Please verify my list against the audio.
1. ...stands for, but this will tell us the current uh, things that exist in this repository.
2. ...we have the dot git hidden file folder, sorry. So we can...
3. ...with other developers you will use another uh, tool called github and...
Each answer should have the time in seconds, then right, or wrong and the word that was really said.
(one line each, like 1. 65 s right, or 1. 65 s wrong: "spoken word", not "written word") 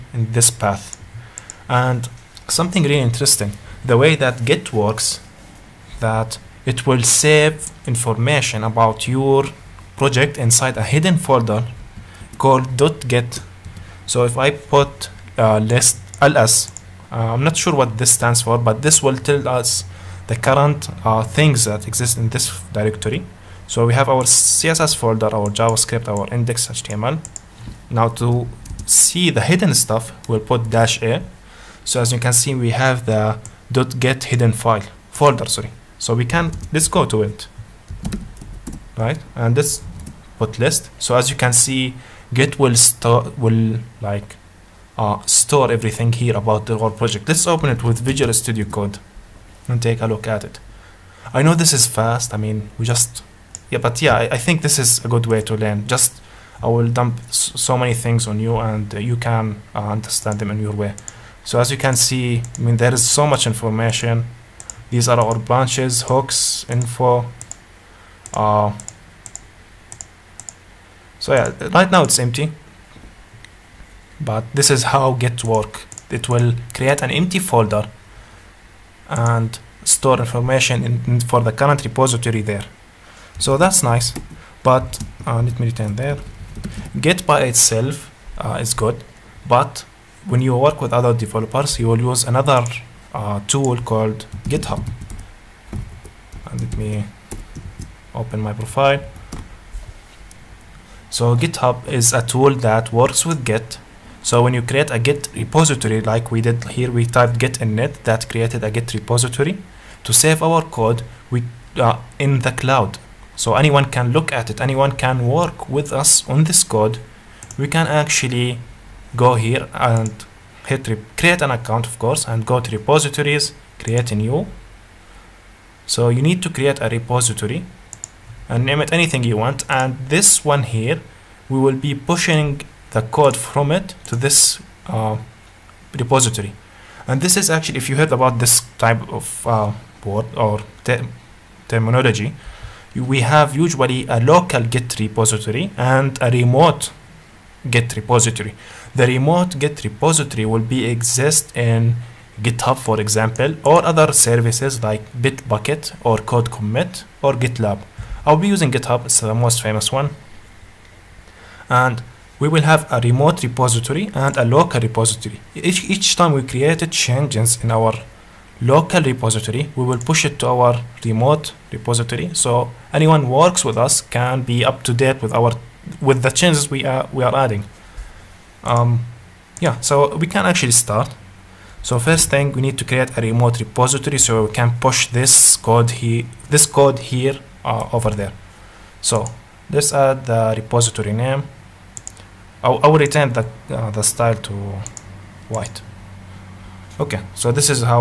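1. 18 s wrong: "directory", not "repository"
2. 32 s right
3. 90 s right.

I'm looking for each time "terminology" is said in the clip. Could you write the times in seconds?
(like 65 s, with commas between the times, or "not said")
141 s.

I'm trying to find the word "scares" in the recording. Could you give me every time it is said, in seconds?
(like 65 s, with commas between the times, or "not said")
not said.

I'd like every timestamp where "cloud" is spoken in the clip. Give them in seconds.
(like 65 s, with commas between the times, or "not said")
112 s.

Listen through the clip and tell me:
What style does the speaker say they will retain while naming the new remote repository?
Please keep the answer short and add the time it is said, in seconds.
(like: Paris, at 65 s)
white, at 195 s.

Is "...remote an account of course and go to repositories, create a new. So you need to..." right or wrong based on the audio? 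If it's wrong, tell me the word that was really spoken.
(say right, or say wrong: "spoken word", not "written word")
wrong: "create", not "remote".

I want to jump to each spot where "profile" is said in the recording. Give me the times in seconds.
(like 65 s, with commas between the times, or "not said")
98 s.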